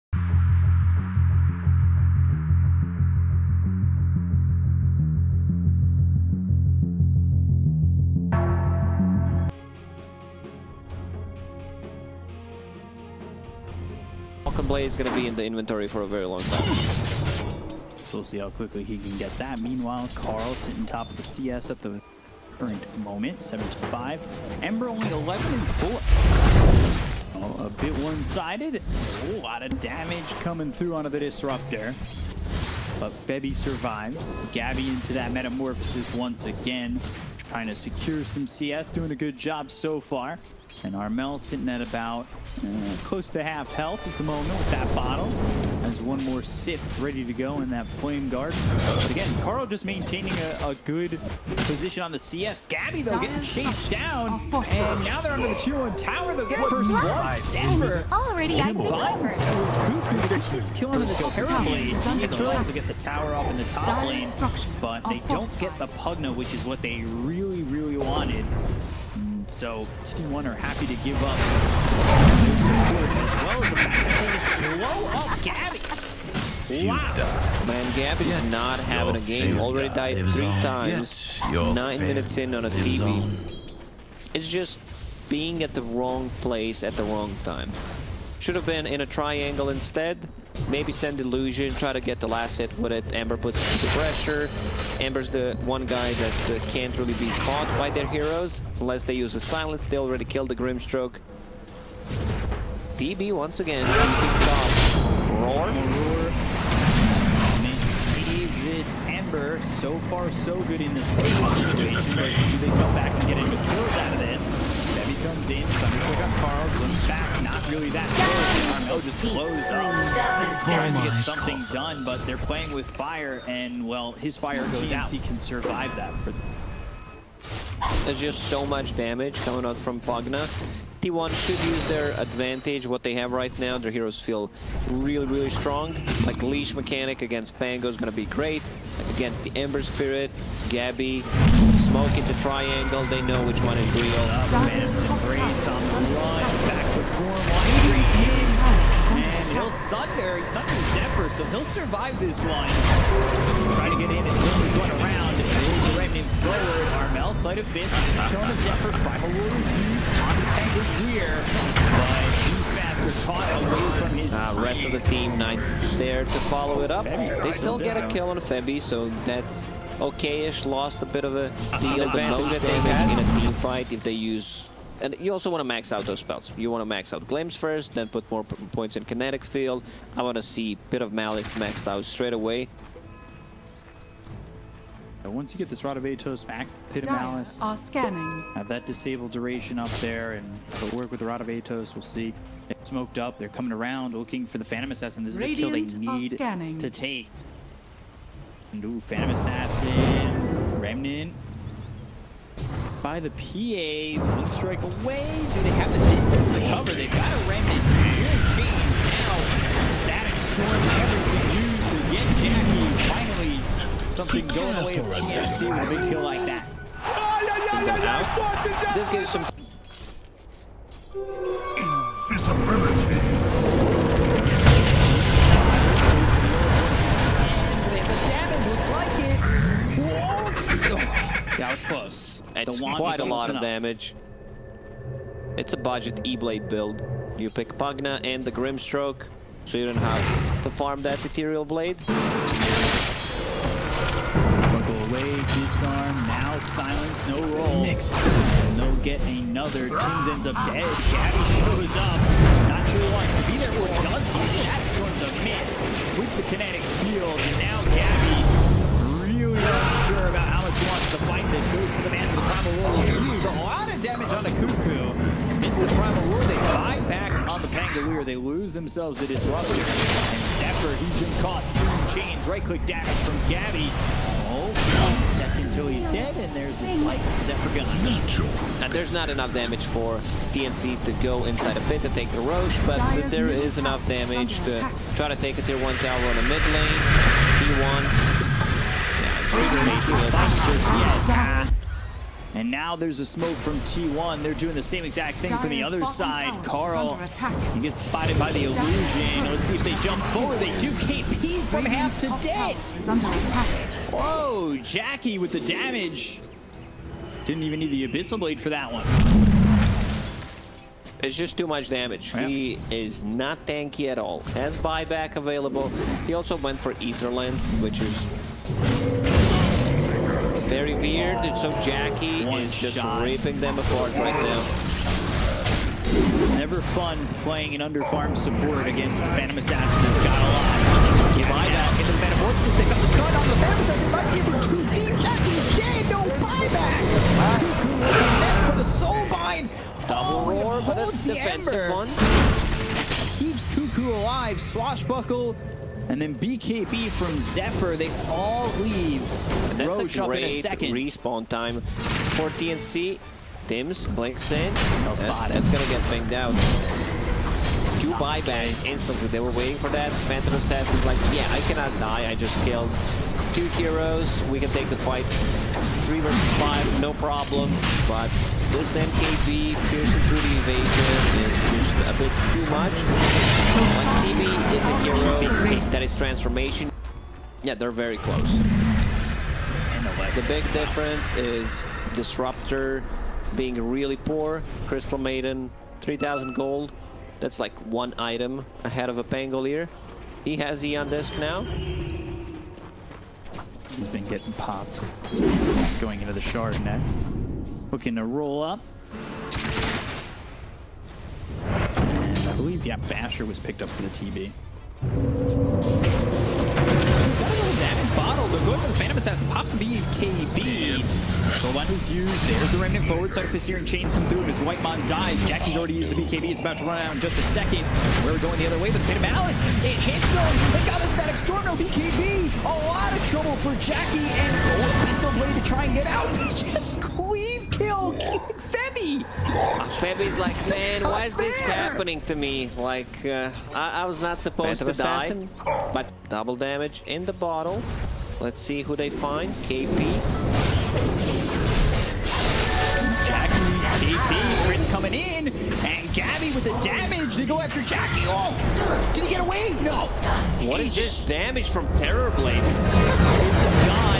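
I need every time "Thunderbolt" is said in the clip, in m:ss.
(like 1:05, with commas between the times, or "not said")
1:55.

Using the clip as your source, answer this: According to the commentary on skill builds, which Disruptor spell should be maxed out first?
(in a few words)
Glimpse.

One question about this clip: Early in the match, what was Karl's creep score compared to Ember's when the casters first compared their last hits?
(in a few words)
7 to 5.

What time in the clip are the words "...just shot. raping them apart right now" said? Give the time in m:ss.
5:22.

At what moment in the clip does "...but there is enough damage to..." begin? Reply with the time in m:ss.
4:42.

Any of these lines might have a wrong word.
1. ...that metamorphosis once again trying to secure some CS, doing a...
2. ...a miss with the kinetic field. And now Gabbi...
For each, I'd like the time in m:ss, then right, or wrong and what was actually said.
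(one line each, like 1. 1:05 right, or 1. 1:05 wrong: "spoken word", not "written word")
1. 0:35 right
2. 4:15 right.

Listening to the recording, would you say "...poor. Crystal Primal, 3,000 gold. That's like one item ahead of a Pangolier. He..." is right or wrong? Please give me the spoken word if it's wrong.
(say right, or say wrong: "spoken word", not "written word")
wrong: "Maiden", not "Primal".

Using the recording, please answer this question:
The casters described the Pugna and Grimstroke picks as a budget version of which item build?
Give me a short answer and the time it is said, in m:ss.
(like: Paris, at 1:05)
E-Blade, at 3:56.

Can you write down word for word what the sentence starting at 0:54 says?
And now they're under the tier 1 tower.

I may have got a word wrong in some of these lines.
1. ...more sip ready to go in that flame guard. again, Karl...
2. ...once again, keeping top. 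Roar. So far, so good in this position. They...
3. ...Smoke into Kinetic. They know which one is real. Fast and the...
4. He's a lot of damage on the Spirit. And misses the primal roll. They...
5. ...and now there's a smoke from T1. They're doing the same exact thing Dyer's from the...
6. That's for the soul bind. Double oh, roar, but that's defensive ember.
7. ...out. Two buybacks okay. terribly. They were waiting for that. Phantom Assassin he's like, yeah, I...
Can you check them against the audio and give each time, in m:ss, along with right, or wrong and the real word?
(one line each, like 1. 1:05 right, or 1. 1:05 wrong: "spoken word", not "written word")
1. 0:46 right
2. 1:43 wrong: "situation", not "position"
3. 2:21 wrong: "Triangle", not "Kinetic"
4. 4:23 wrong: "Kuku", not "Spirit"
5. 4:52 right
6. 5:38 right
7. 5:56 wrong: "instantly", not "terribly".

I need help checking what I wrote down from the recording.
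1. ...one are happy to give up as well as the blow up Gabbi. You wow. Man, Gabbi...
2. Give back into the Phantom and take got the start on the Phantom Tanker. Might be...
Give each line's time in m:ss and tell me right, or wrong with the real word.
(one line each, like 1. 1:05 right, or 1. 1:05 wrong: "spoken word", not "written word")
1. 1:10 right
2. 5:31 wrong: "Assassin", not "Tanker".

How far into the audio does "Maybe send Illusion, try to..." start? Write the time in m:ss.
1:30.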